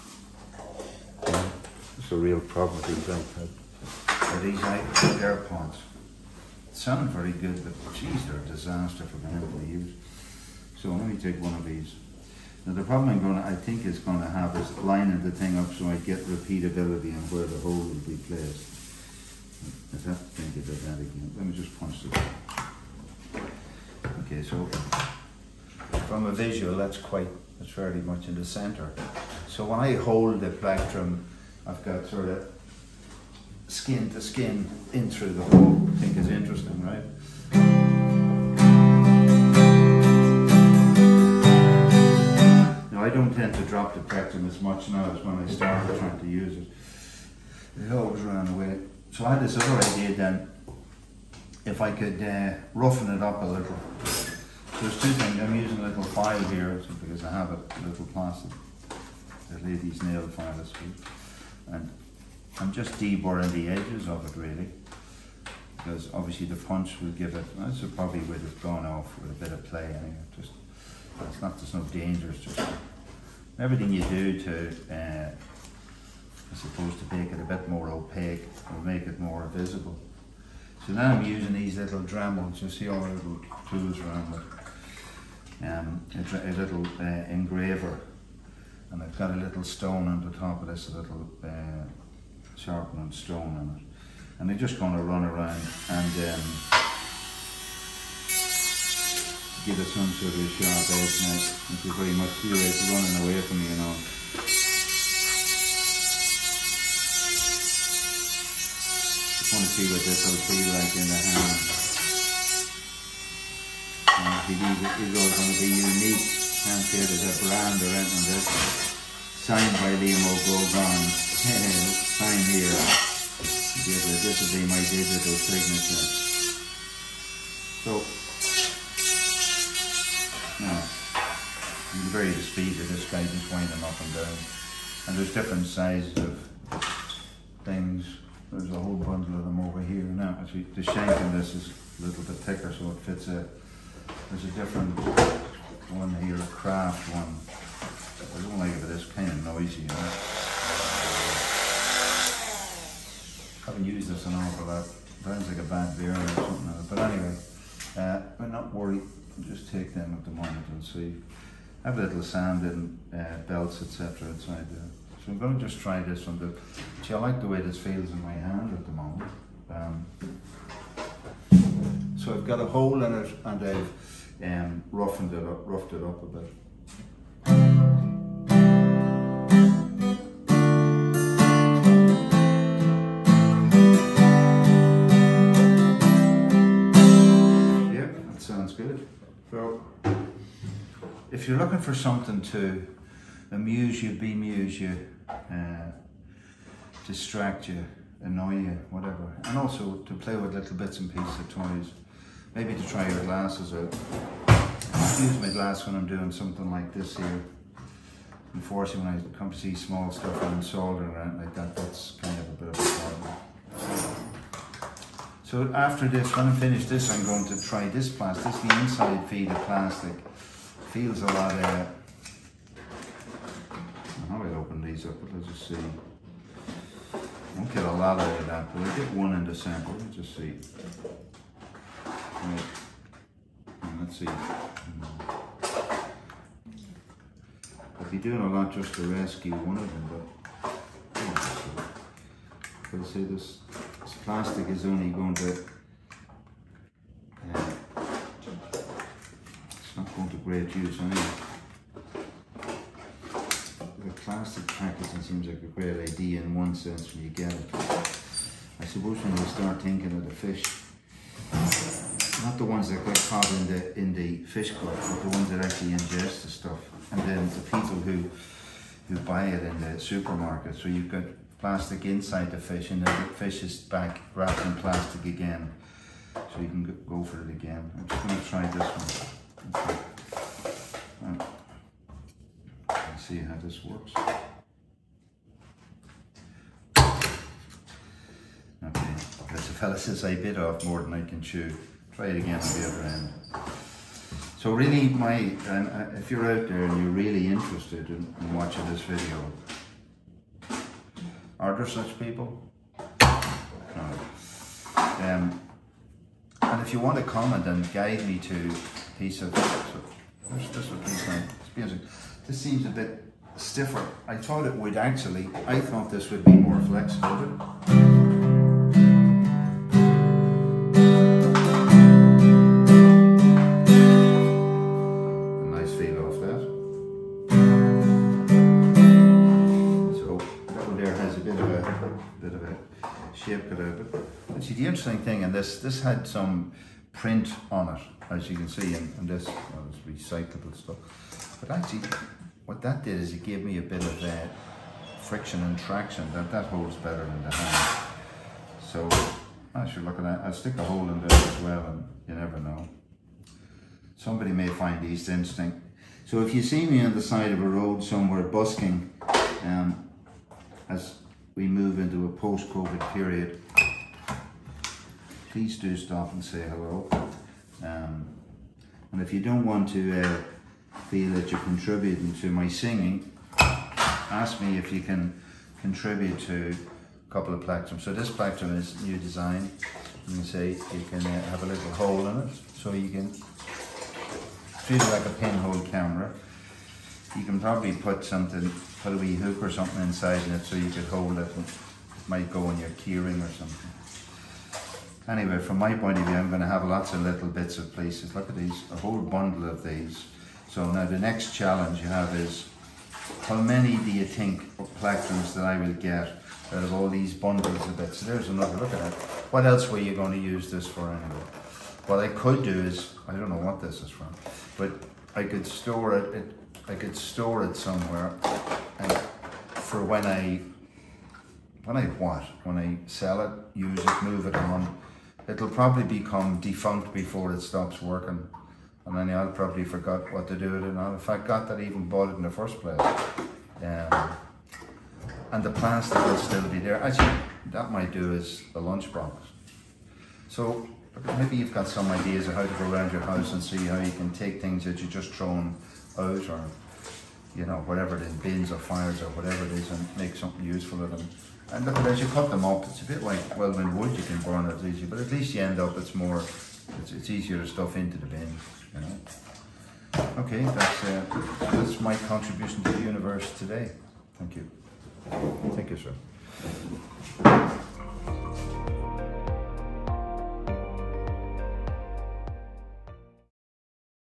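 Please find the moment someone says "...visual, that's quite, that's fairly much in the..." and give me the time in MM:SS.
00:26.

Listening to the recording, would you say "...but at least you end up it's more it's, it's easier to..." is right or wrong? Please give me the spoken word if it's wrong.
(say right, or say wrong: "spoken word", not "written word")
right.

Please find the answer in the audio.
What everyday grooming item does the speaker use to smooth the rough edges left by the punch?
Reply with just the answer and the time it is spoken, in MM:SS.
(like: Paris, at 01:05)
a lady's nail file, at 00:59.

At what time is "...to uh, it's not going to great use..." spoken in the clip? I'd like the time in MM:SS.
04:05.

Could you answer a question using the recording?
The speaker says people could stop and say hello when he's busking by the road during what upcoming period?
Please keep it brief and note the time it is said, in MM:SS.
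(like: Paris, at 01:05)
post-COVID period, at 06:02.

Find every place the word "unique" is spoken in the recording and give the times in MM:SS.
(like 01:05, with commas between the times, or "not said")
01:55.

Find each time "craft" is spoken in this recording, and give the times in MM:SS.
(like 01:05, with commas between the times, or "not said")
02:26.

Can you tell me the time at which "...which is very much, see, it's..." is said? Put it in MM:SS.
01:41.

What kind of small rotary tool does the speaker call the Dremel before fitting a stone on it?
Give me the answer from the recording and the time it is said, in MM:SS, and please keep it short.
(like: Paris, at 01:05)
engraver, at 01:27.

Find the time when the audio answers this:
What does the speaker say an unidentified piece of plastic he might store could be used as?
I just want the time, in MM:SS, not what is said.
07:18.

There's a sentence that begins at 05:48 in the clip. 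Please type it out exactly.
So I should look at that.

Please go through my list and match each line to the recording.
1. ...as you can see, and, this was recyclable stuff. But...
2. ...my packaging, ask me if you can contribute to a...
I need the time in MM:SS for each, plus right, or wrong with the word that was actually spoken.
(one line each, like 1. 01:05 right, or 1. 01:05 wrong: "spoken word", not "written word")
1. 05:38 right
2. 06:12 wrong: "singing", not "packaging".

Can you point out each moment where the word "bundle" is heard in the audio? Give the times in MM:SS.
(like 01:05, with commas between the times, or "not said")
02:18, 06:39, 06:47.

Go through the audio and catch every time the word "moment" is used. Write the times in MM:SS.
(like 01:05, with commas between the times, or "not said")
02:40, 02:48.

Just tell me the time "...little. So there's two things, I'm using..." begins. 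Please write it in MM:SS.
00:53.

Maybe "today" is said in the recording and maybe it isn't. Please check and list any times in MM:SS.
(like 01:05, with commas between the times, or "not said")
07:43.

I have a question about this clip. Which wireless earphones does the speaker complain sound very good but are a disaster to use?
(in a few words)
AirPods.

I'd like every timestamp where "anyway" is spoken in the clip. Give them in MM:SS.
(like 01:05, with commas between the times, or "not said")
01:09, 02:37, 04:10, 06:35, 06:51.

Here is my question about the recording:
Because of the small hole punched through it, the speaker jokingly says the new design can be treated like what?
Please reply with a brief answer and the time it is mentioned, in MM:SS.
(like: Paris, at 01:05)
a pinhole camera, at 06:25.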